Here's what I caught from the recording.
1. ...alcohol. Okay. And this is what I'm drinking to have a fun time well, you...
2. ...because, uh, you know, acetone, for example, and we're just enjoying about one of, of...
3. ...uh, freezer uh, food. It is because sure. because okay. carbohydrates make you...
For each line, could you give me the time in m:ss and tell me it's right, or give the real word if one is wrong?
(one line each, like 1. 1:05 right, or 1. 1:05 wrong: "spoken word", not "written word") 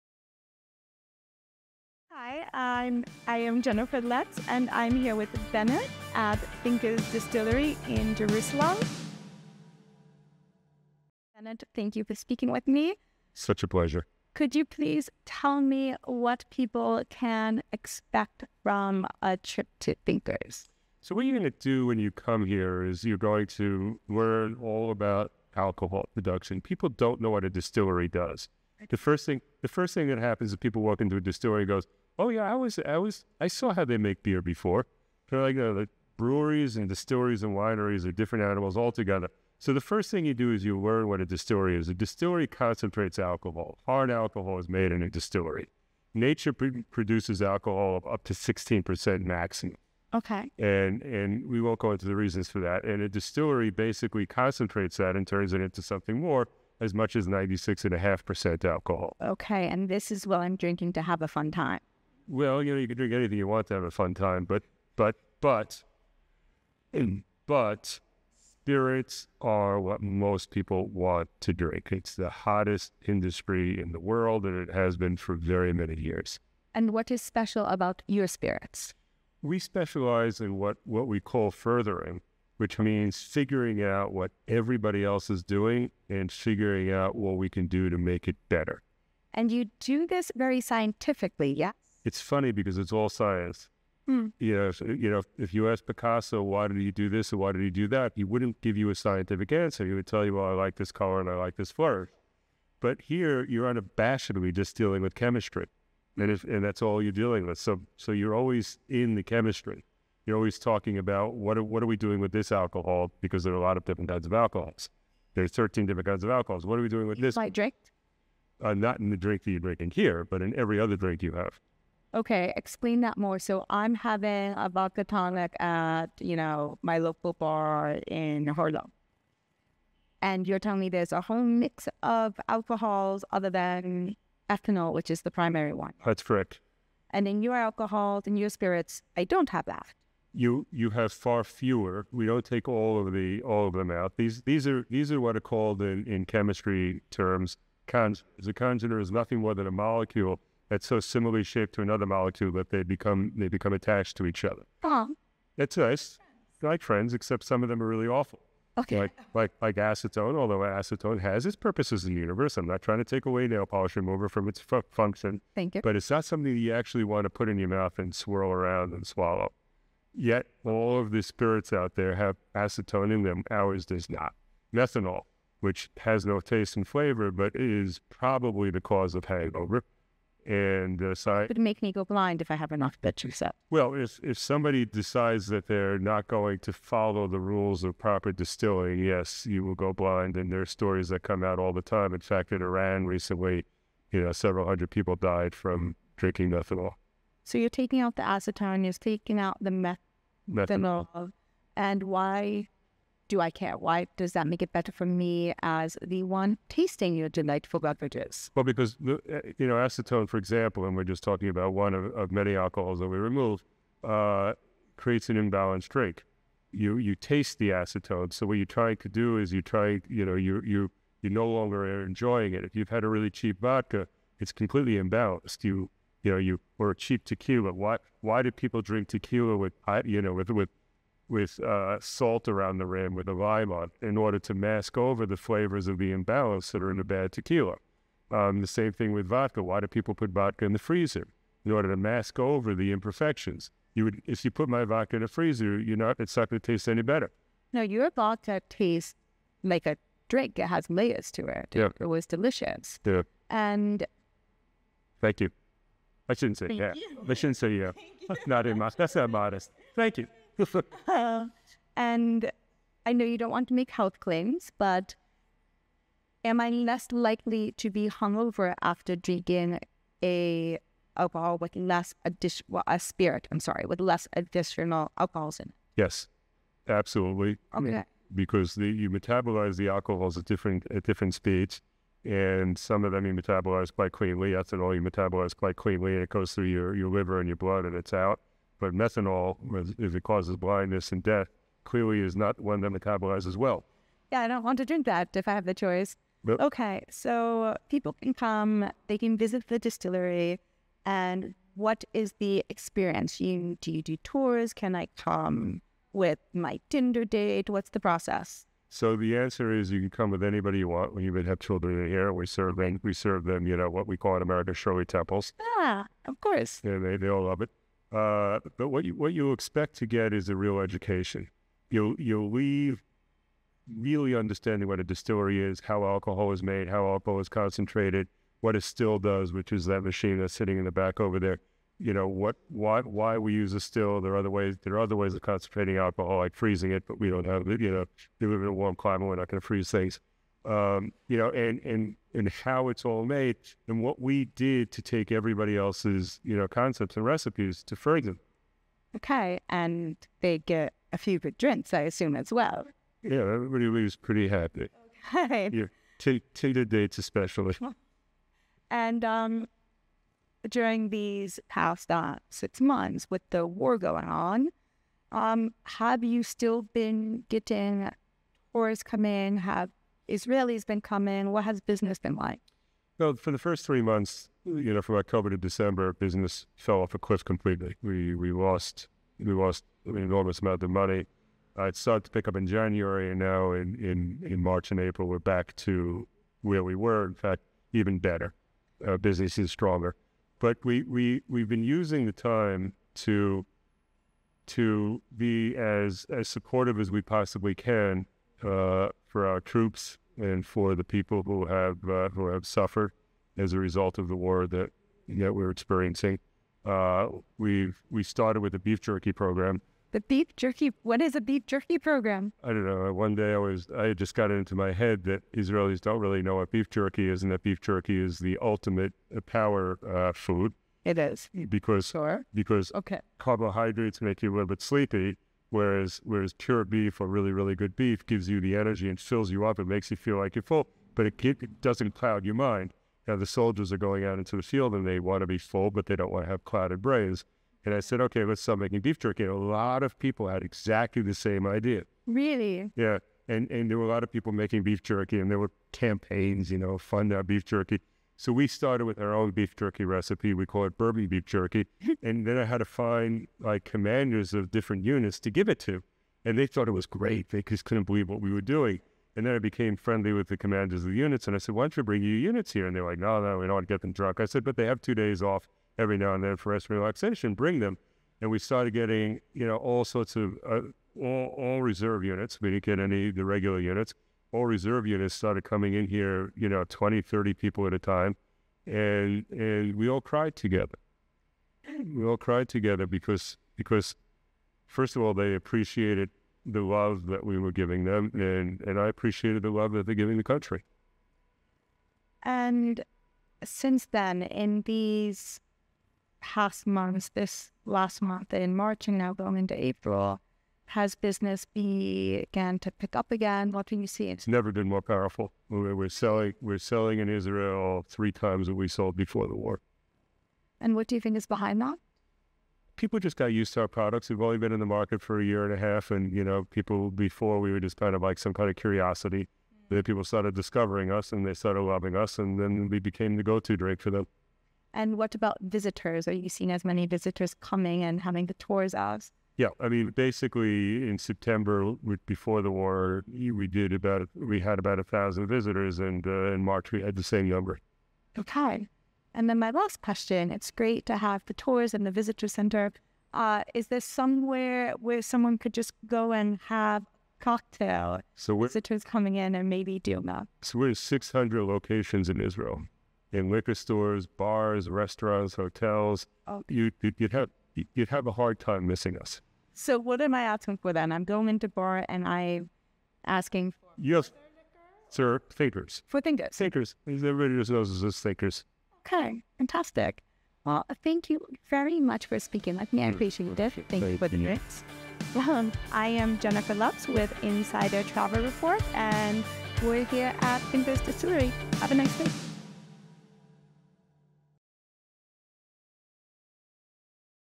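1. 0:58 right
2. 3:28 wrong: "talking", not "enjoying"
3. 6:59 wrong: "power", not "freezer".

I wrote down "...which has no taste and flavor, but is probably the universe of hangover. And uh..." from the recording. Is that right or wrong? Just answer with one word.
wrong.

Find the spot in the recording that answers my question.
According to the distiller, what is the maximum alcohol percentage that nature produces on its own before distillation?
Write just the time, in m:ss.
0:48.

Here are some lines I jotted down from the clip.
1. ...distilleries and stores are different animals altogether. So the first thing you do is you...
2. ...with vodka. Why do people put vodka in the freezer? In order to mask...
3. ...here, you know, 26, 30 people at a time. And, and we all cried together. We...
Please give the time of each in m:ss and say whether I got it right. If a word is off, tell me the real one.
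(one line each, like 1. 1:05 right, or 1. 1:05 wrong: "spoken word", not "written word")
1. 0:36 wrong: "wineries", not "stores"
2. 3:59 right
3. 7:56 wrong: "20", not "26".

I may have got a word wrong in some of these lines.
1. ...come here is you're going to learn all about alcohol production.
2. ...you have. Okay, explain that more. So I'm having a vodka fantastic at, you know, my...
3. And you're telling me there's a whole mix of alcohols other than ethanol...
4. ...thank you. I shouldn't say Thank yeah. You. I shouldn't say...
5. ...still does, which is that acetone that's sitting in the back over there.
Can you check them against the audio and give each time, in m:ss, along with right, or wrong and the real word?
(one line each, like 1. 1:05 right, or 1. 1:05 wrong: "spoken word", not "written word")
1. 0:22 right
2. 2:01 wrong: "tonic", not "fantastic"
3. 2:10 right
4. 4:15 right
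5. 5:28 wrong: "machine", not "acetone".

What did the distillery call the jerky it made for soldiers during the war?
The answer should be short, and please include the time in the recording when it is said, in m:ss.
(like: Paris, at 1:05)
Bourbon beef jerky, at 7:30.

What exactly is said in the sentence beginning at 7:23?
And and there were a lot of people making beef jerky, and there were campaigns, you know, fund our beef jerky.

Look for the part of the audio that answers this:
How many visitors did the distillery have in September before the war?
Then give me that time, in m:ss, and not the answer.
8:54.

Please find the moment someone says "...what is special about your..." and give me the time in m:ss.
1:16.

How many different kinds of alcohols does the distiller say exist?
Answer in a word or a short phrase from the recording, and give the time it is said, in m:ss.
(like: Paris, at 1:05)
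13, at 1:55.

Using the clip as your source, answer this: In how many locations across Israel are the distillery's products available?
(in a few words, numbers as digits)
600.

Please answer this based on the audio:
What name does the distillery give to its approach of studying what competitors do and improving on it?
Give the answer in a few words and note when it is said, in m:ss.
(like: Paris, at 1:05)
Furthering, at 1:21.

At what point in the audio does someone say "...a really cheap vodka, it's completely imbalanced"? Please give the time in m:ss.
3:43.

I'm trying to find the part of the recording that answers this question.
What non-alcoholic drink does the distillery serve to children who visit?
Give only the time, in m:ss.
5:14.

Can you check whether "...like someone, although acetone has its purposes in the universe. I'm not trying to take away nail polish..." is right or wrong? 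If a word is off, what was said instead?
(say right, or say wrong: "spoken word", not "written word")
wrong: "acetone", not "someone".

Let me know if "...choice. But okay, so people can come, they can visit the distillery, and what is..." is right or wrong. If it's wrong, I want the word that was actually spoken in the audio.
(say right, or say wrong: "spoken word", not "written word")
right.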